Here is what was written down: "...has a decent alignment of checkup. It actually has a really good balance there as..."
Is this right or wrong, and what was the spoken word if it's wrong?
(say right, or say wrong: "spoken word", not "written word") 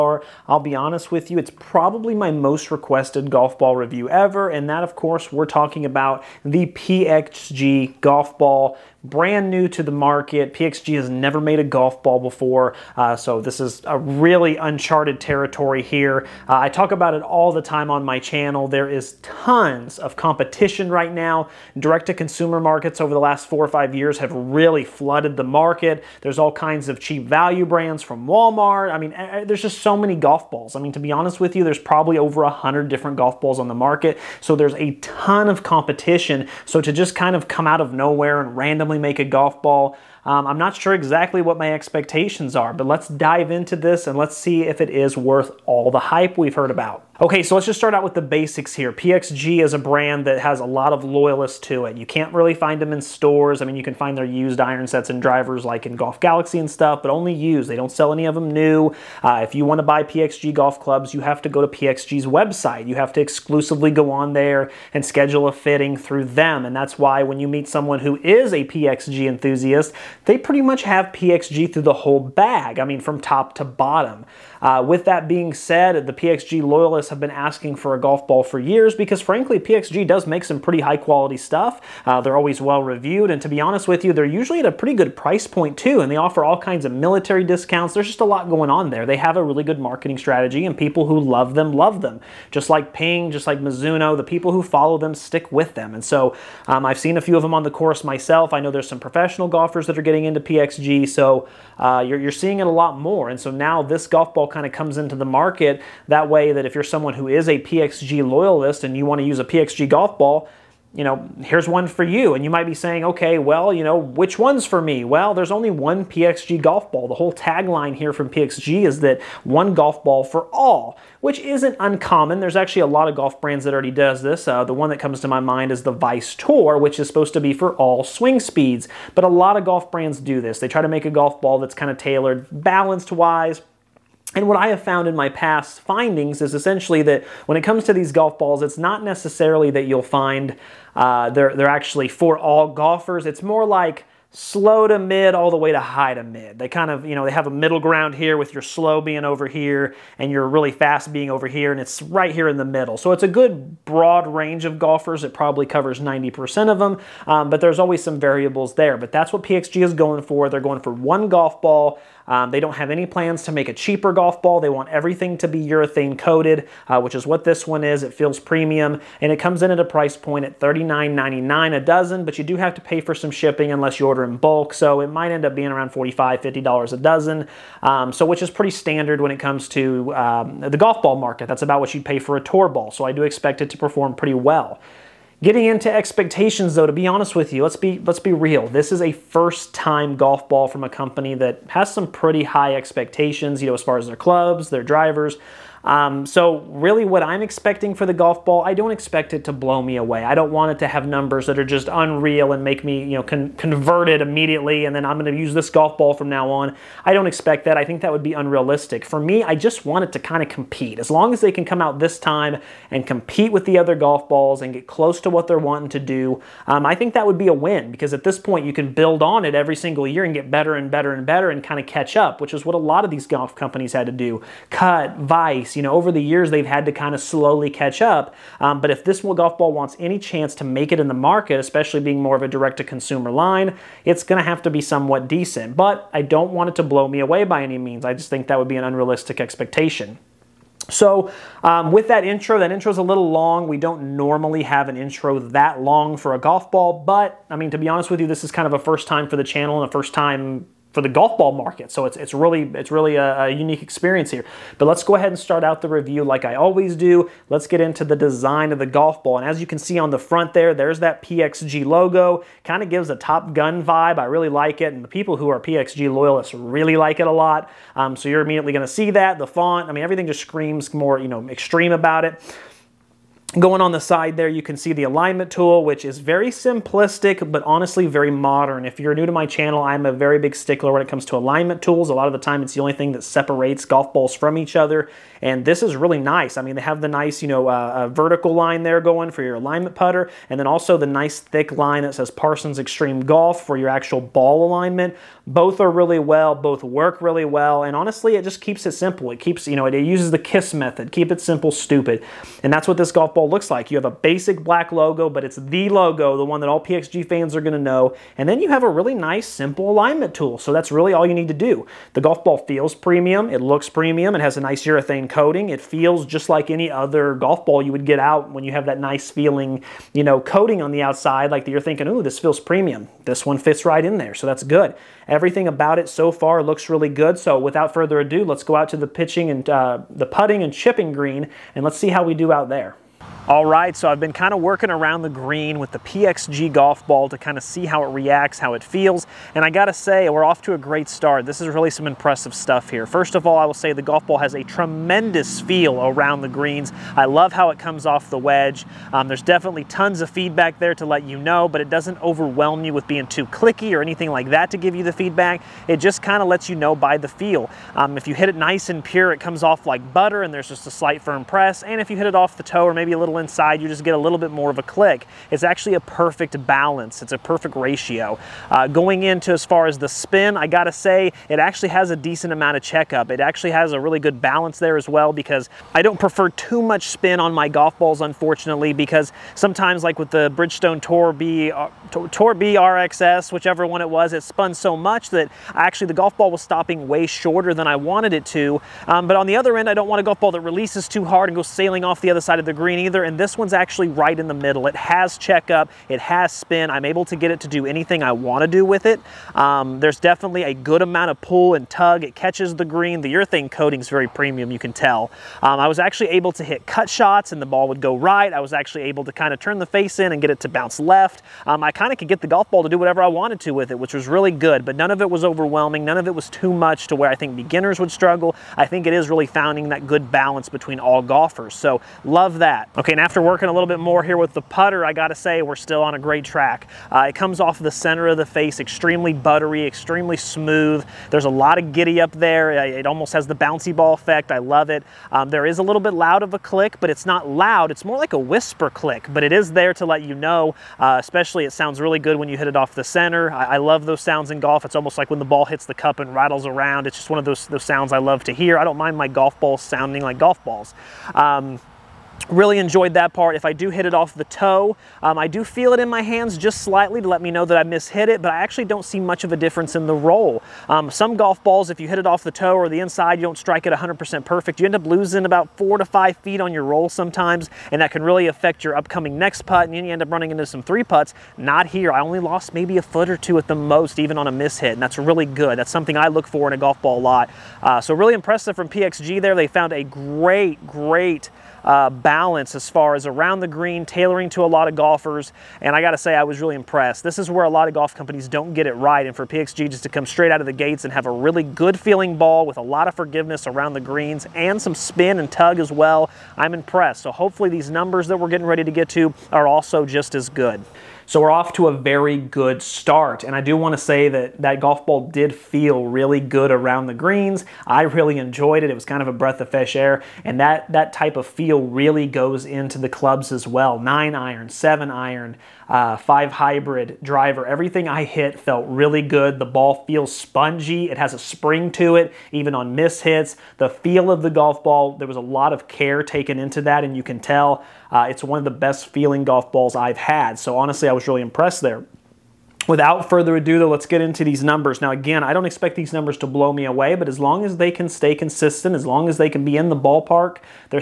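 wrong: "amount", not "alignment".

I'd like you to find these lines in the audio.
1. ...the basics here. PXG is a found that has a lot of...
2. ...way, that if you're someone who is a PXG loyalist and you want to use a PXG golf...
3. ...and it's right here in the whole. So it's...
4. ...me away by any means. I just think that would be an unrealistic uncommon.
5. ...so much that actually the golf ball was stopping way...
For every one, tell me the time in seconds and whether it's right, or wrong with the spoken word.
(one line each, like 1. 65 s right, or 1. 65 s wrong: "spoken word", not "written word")
1. 48 s wrong: "brand", not "found"
2. 106 s right
3. 151 s wrong: "middle", not "whole"
4. 237 s wrong: "expectation", not "uncommon"
5. 384 s right.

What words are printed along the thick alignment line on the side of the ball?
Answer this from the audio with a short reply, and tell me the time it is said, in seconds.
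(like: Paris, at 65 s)
Parsons Extreme Golf, at 292 s.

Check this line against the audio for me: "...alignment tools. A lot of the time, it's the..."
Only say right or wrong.
right.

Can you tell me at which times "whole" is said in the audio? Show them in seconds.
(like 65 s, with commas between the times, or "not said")
71 s, 117 s.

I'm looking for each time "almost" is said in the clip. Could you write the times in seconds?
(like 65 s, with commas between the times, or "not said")
433 s, 444 s.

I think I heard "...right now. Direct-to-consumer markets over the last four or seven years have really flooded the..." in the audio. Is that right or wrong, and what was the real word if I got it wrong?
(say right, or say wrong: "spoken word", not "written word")
wrong: "five", not "seven".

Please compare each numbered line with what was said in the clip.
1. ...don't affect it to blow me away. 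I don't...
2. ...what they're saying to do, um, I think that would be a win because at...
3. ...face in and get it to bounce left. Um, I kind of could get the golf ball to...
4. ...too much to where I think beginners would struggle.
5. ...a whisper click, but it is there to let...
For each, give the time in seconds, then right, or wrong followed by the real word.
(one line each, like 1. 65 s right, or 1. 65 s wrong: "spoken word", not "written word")
1. 198 s wrong: "expect", not "affect"
2. 215 s wrong: "wanting", not "saying"
3. 409 s right
4. 416 s right
5. 438 s right.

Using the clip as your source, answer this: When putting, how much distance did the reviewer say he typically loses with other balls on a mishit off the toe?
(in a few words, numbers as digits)
4 to 5 feet.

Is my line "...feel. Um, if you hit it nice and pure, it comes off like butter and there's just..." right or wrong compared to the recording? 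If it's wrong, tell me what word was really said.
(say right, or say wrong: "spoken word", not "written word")
right.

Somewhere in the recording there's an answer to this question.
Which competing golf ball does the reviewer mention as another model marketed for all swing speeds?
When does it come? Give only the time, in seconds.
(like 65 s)
125 s.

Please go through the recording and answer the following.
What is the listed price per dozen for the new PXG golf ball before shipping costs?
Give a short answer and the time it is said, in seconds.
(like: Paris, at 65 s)
$39.99, at 170 s.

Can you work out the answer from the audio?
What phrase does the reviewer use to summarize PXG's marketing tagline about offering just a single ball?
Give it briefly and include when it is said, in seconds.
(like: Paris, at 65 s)
One golf ball for all, at 119 s.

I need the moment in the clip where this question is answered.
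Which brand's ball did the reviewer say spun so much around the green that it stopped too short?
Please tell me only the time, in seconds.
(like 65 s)
380 s.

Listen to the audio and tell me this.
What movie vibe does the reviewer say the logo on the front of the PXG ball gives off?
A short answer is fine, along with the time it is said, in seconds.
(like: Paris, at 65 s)
Top Gun, at 263 s.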